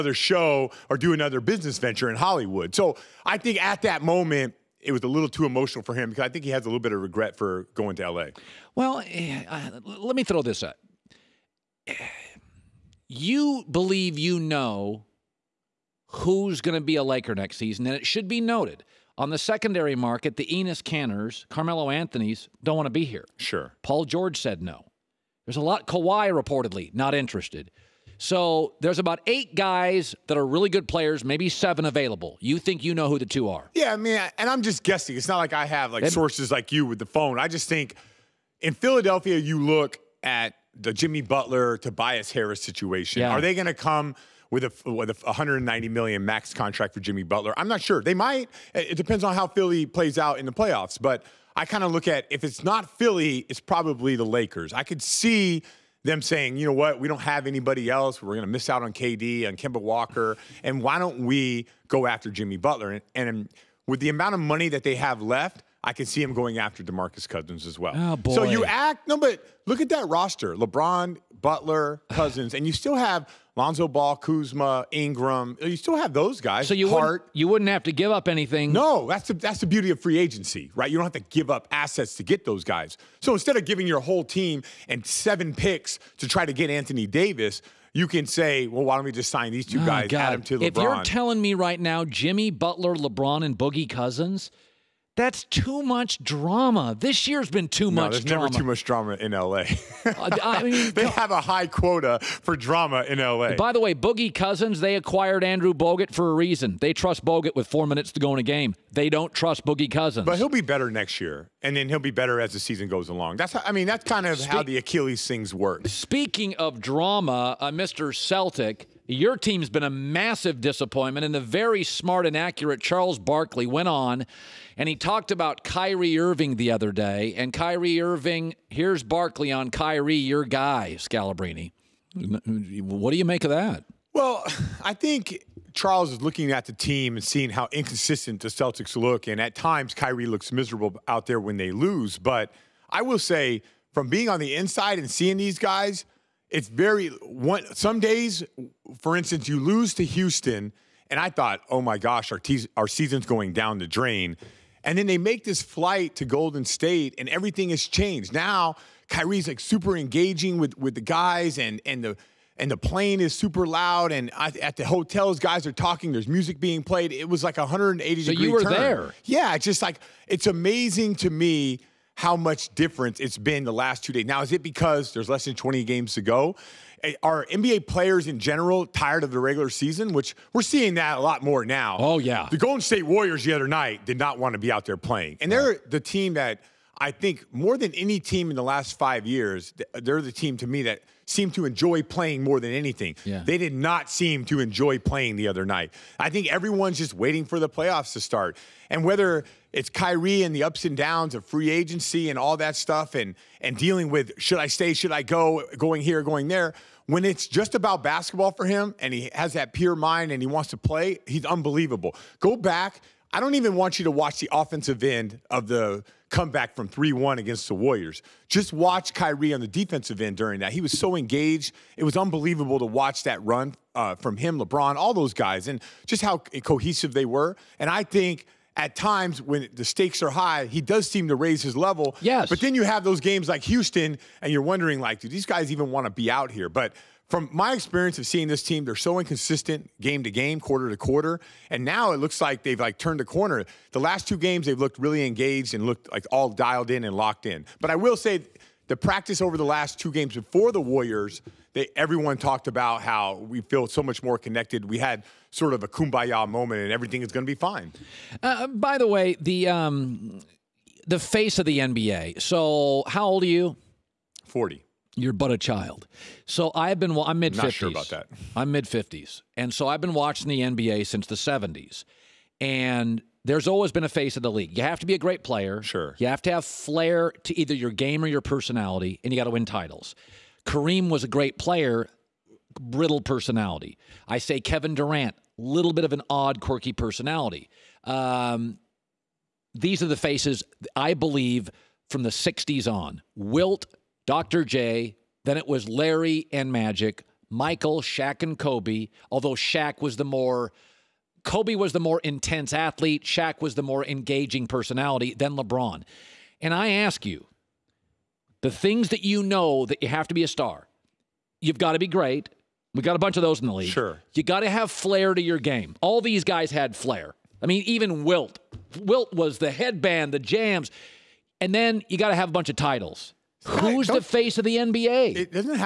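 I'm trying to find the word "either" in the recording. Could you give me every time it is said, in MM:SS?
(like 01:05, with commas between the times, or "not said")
04:37.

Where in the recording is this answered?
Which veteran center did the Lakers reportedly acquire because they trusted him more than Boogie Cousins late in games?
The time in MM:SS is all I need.
01:45.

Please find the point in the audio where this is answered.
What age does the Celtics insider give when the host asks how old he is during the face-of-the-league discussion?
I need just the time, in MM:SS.
04:24.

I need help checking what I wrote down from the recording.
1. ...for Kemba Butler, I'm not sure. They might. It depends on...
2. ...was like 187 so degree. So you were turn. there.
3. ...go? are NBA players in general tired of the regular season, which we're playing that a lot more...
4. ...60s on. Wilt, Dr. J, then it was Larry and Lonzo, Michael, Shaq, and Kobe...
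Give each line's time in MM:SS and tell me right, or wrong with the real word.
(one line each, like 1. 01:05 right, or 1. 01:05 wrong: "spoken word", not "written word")
1. 00:46 wrong: "Jimmy", not "Kemba"
2. 02:47 wrong: "180", not "187"
3. 02:56 wrong: "seeing", not "playing"
4. 04:52 wrong: "Magic", not "Lonzo".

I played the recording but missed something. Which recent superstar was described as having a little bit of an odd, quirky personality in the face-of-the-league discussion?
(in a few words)
Kevin Durant.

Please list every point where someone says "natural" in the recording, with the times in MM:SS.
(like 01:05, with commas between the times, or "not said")
not said.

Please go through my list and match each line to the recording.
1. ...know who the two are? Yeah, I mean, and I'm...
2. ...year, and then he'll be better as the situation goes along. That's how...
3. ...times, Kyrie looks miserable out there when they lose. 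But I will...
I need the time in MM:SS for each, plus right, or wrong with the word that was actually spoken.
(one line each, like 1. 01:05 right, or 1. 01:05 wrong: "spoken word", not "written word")
1. 00:32 right
2. 01:51 wrong: "season", not "situation"
3. 02:19 right.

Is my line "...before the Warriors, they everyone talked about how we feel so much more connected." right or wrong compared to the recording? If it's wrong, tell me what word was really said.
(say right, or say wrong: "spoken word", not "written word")
right.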